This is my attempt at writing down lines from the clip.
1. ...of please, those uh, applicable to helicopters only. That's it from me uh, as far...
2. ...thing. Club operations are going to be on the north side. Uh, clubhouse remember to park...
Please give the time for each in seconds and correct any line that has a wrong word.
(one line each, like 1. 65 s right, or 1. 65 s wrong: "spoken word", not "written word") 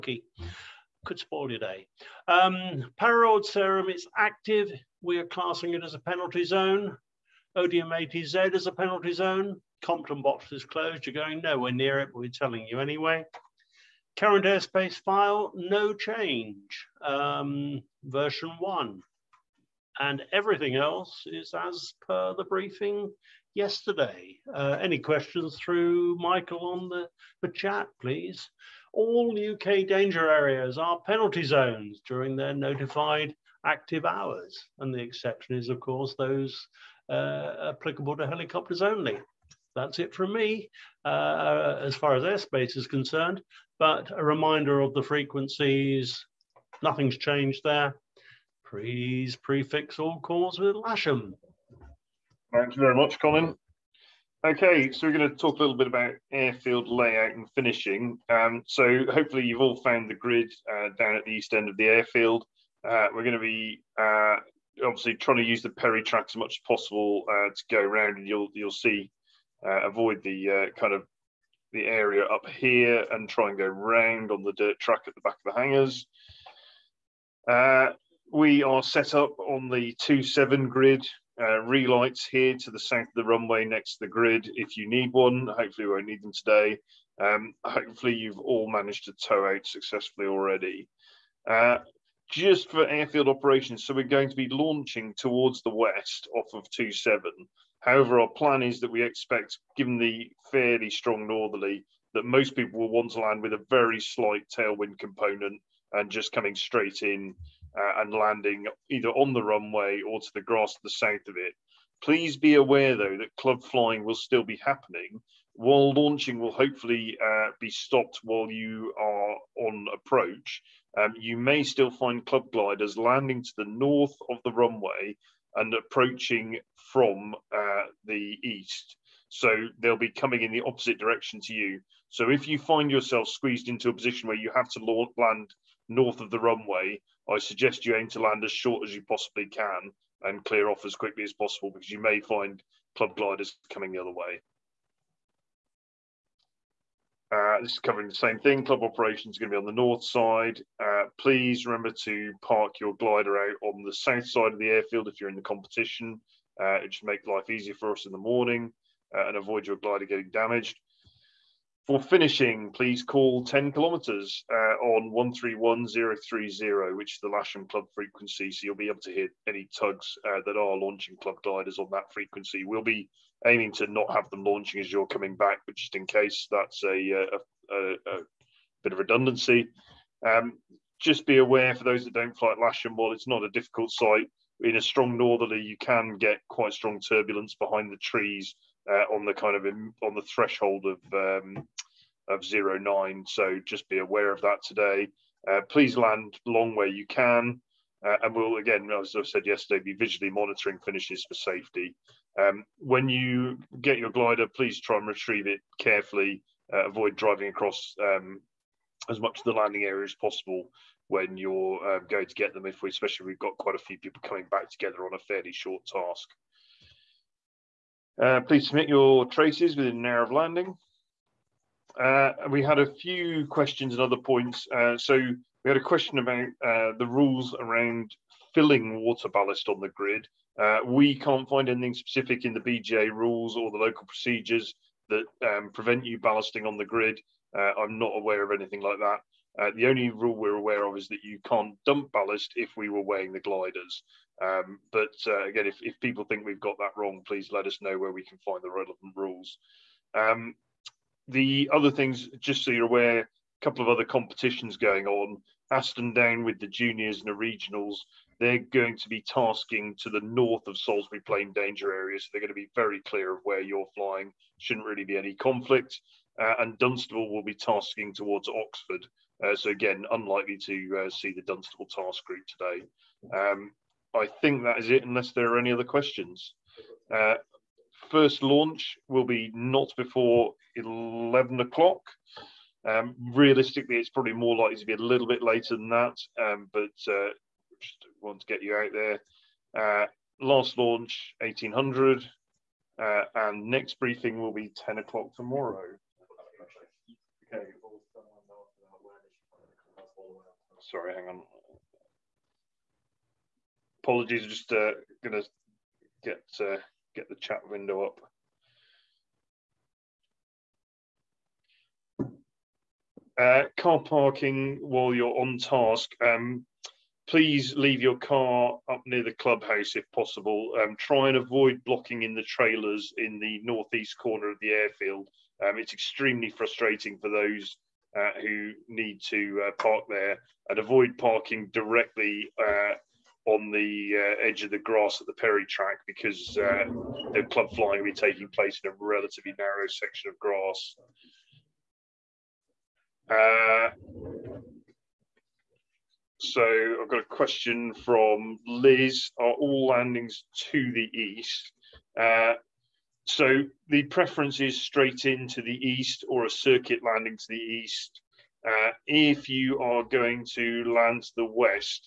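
1. 35 s wrong: "course", not "please"
2. 148 s wrong: "please", not "clubhouse".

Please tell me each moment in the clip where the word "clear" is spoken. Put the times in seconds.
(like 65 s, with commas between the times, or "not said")
140 s, 263 s.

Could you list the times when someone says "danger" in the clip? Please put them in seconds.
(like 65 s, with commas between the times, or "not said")
29 s, 261 s.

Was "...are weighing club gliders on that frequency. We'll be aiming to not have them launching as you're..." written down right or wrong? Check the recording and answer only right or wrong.
wrong.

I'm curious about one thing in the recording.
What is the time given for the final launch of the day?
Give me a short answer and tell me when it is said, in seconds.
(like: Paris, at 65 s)
1800, at 291 s.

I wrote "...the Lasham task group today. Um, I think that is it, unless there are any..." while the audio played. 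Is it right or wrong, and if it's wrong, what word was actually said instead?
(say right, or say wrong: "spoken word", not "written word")
wrong: "Dunstable", not "Lasham".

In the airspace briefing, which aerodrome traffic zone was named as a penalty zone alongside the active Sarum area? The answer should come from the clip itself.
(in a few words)
Odiham.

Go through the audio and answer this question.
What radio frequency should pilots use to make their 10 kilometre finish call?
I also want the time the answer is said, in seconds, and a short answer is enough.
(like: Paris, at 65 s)
131030, at 165 s.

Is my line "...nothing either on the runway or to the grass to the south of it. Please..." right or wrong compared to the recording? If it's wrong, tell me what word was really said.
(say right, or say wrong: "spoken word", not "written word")
wrong: "landing", not "nothing".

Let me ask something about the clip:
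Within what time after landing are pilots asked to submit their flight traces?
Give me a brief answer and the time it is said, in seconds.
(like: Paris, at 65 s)
an hour, at 219 s.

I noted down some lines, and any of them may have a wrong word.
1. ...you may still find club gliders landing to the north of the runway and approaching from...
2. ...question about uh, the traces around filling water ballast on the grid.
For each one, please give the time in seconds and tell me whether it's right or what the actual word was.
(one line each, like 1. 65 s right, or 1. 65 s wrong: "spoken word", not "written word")
1. 121 s right
2. 225 s wrong: "rules", not "traces".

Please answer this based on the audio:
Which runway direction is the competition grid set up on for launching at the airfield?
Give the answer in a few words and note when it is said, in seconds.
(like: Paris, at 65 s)
27, at 79 s.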